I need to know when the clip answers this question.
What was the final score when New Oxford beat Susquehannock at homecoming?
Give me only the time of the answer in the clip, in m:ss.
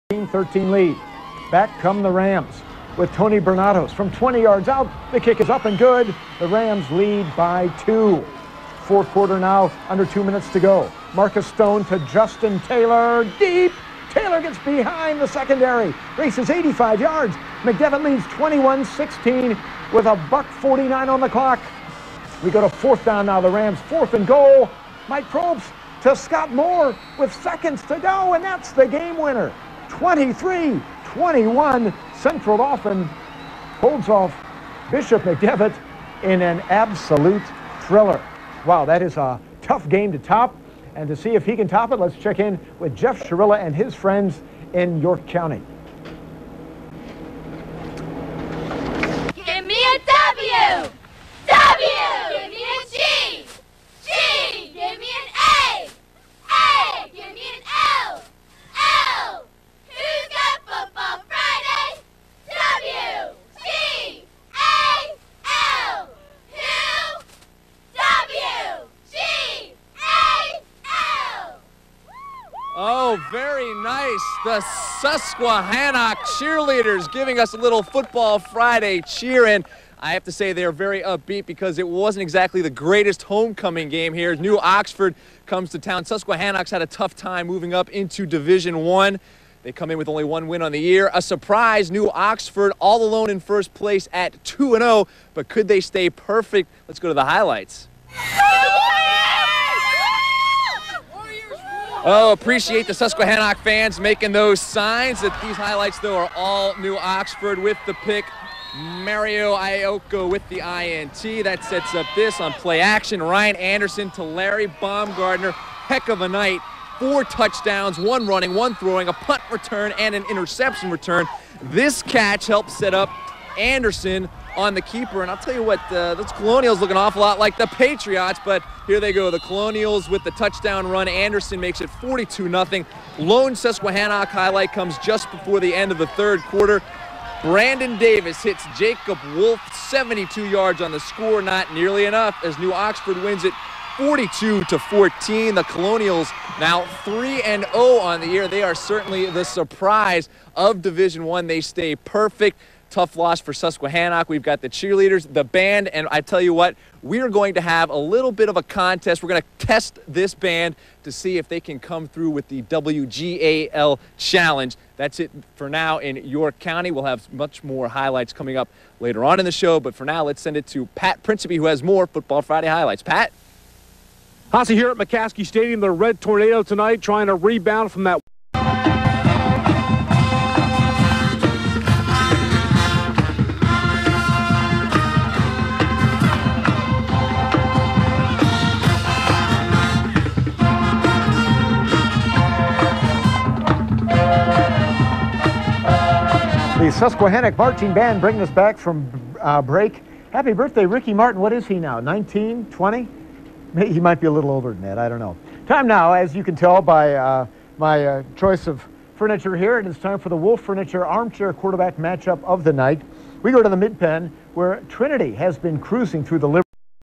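2:23.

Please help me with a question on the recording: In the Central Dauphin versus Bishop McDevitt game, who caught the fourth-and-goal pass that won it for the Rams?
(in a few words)
Scott Moore.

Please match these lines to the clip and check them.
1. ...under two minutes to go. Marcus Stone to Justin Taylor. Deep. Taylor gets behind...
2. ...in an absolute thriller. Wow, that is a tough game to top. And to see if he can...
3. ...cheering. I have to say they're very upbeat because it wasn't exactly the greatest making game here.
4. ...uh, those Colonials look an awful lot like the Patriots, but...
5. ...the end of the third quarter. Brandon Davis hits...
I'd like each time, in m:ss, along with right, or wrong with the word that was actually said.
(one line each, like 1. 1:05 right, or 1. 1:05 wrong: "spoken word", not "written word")
1. 0:09 right
2. 0:36 right
3. 1:19 wrong: "homecoming", not "making"
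4. 2:05 right
5. 2:15 right.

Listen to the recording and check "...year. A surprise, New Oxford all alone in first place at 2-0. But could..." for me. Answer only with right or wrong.
right.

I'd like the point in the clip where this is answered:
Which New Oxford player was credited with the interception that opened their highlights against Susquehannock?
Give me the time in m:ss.
1:48.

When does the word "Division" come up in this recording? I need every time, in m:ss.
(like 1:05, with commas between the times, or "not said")
1:28, 2:30.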